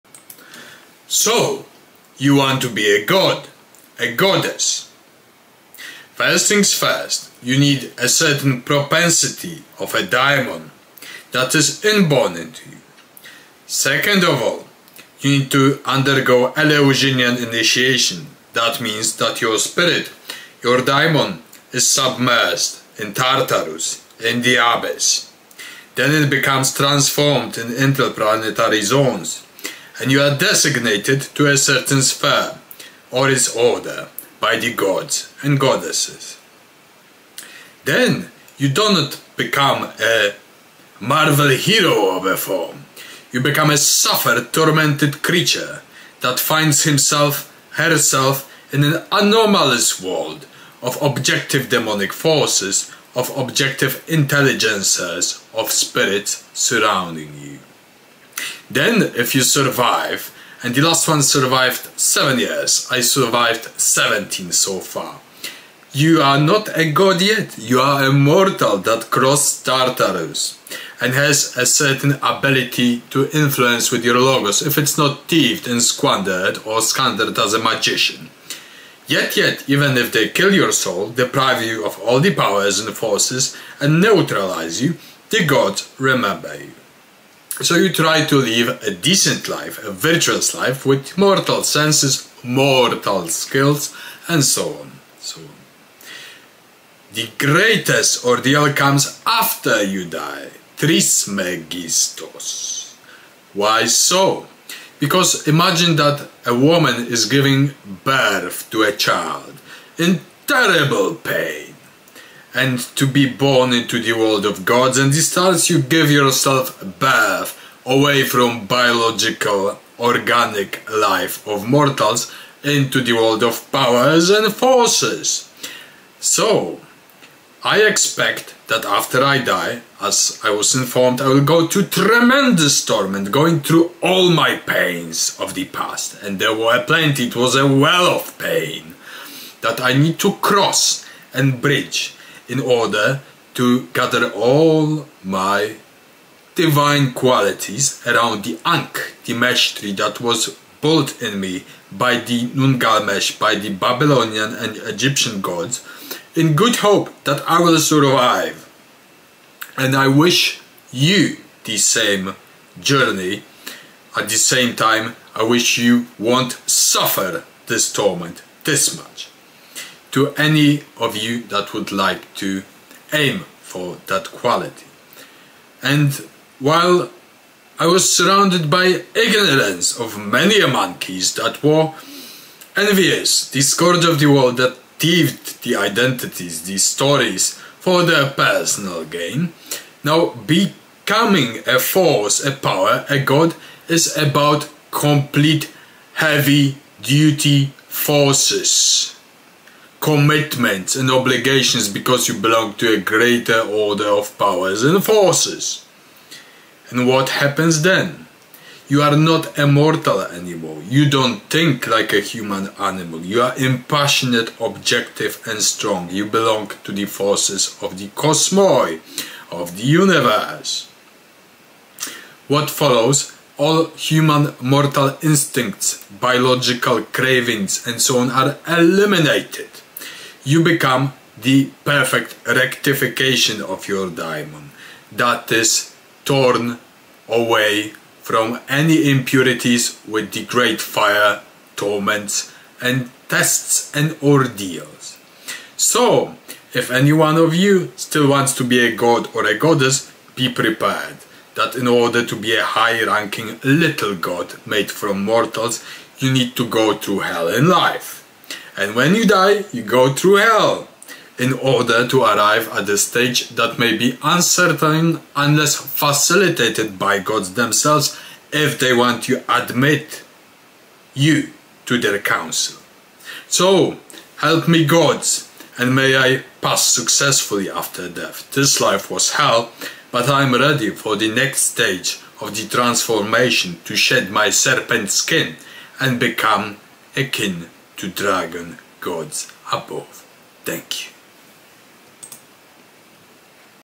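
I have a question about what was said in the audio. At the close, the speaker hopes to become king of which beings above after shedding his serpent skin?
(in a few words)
Dragon Gods.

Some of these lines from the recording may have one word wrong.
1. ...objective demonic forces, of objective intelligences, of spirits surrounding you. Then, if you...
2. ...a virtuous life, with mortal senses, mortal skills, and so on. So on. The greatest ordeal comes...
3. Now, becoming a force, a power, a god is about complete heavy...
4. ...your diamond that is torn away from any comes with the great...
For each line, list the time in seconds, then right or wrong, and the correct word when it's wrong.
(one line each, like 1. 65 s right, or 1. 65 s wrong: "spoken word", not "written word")
1. 51 s right
2. 89 s right
3. 190 s right
4. 233 s wrong: "impurities", not "comes".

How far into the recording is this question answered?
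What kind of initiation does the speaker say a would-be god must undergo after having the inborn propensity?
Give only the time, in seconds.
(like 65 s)
16 s.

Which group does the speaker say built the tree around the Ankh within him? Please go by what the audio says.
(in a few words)
Nungalmesh.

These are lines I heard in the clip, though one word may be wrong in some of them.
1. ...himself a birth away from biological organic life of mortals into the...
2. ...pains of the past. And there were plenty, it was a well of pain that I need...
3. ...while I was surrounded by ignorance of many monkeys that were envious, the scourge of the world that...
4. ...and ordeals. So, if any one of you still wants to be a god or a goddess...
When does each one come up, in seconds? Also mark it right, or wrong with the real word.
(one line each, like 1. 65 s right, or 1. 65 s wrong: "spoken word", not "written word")
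1. 116 s wrong: "yourself", not "himself"
2. 134 s right
3. 176 s right
4. 243 s right.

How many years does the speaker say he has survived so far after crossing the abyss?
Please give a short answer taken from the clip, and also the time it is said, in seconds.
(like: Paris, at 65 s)
17, at 63 s.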